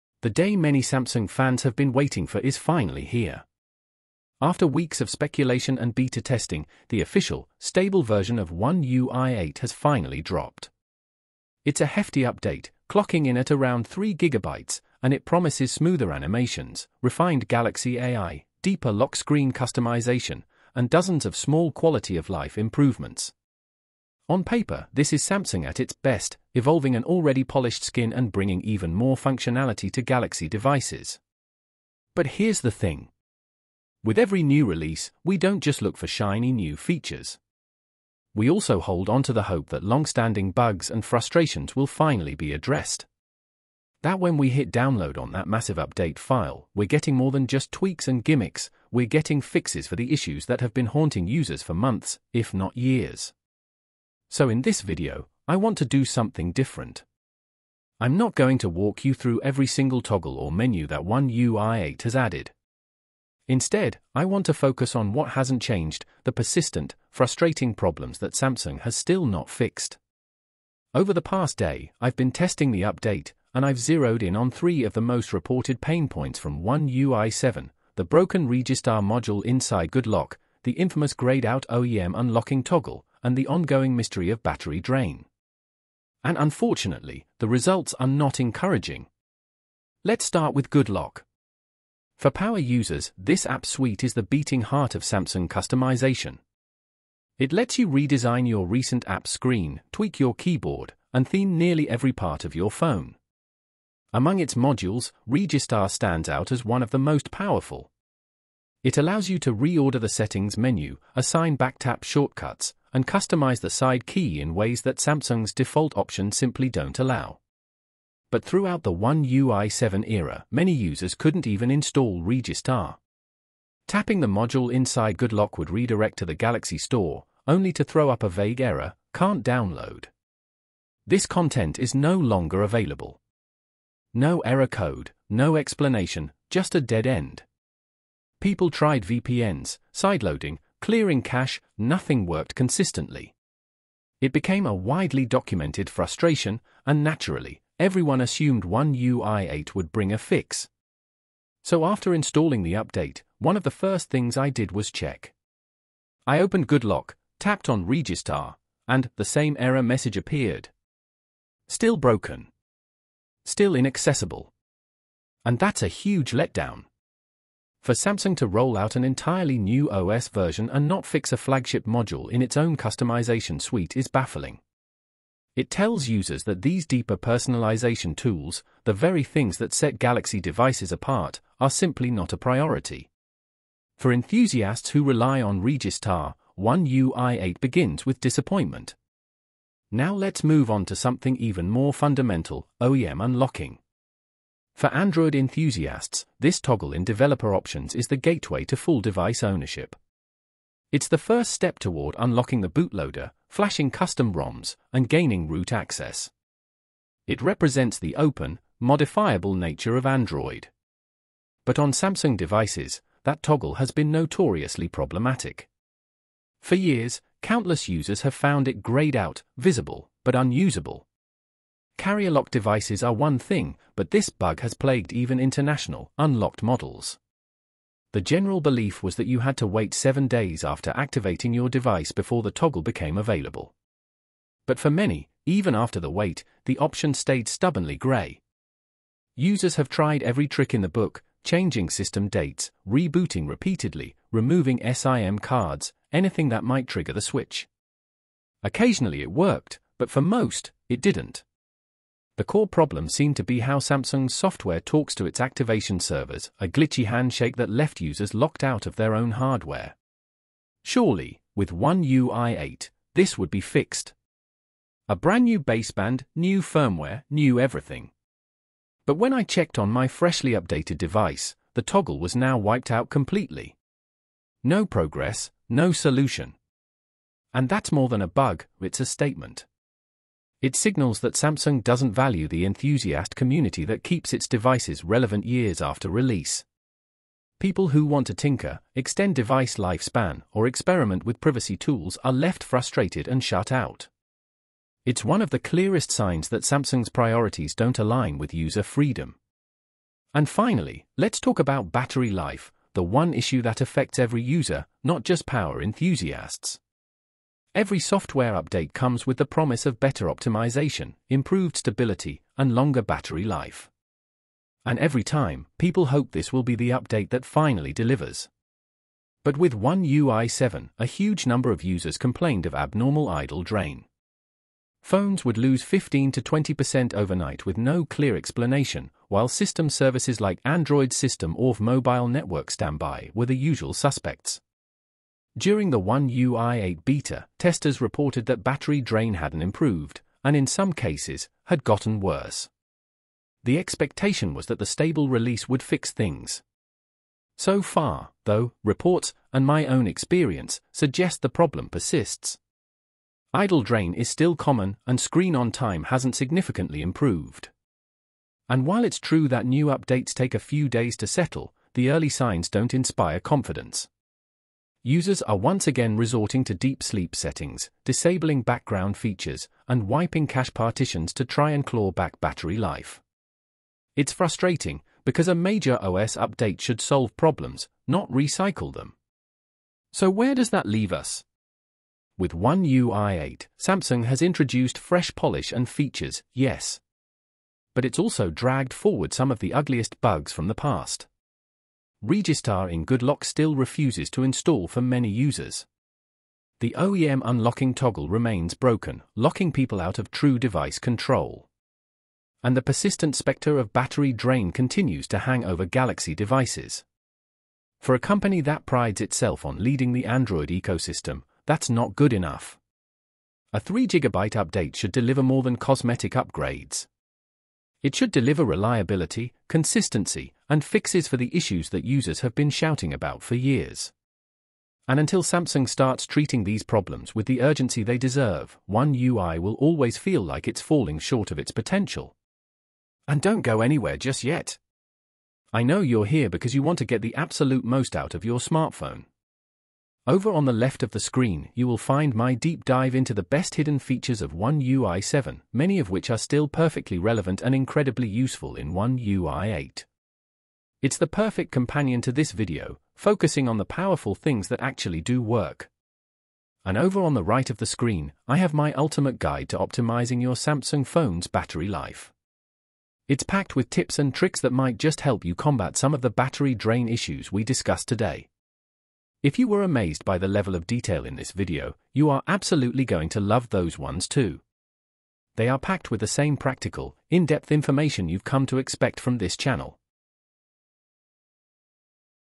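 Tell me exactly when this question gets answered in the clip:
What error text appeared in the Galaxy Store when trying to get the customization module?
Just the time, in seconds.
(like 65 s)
129 s.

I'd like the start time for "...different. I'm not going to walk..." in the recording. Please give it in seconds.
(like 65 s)
56 s.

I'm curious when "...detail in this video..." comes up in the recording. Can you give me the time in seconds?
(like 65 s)
470 s.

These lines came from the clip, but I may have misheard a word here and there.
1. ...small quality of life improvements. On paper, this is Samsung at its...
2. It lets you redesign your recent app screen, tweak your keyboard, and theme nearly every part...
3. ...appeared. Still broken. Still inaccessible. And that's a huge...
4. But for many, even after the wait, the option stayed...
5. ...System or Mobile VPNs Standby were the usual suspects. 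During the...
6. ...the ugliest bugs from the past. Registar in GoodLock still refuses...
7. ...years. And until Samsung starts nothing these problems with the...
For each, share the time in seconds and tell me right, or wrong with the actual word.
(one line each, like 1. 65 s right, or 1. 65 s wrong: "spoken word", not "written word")
1. 21 s right
2. 97 s right
3. 160 s right
4. 234 s right
5. 331 s wrong: "Network", not "VPNs"
6. 389 s right
7. 423 s wrong: "treating", not "nothing".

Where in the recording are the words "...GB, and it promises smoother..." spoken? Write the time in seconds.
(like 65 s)
14 s.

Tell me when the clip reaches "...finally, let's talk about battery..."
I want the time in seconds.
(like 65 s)
300 s.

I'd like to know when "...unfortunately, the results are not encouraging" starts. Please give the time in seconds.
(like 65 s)
86 s.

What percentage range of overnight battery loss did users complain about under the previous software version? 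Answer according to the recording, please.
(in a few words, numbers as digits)
15 to 20%.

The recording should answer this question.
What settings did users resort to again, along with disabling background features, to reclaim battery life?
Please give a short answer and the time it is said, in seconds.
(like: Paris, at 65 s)
deep sleep settings, at 366 s.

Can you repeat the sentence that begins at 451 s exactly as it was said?
It's the perfect companion to this video, focusing on the powerful things that actually do work.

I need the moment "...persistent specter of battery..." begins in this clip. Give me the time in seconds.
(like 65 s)
402 s.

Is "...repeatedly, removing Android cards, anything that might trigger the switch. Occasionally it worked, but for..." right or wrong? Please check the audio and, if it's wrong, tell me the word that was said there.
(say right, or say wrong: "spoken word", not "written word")
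wrong: "SIM", not "Android".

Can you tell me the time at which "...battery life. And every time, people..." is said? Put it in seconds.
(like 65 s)
313 s.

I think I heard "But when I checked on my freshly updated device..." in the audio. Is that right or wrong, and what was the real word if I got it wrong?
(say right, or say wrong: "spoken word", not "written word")
right.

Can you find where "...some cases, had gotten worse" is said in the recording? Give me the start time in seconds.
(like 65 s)
340 s.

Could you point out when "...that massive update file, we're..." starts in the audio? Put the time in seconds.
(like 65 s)
45 s.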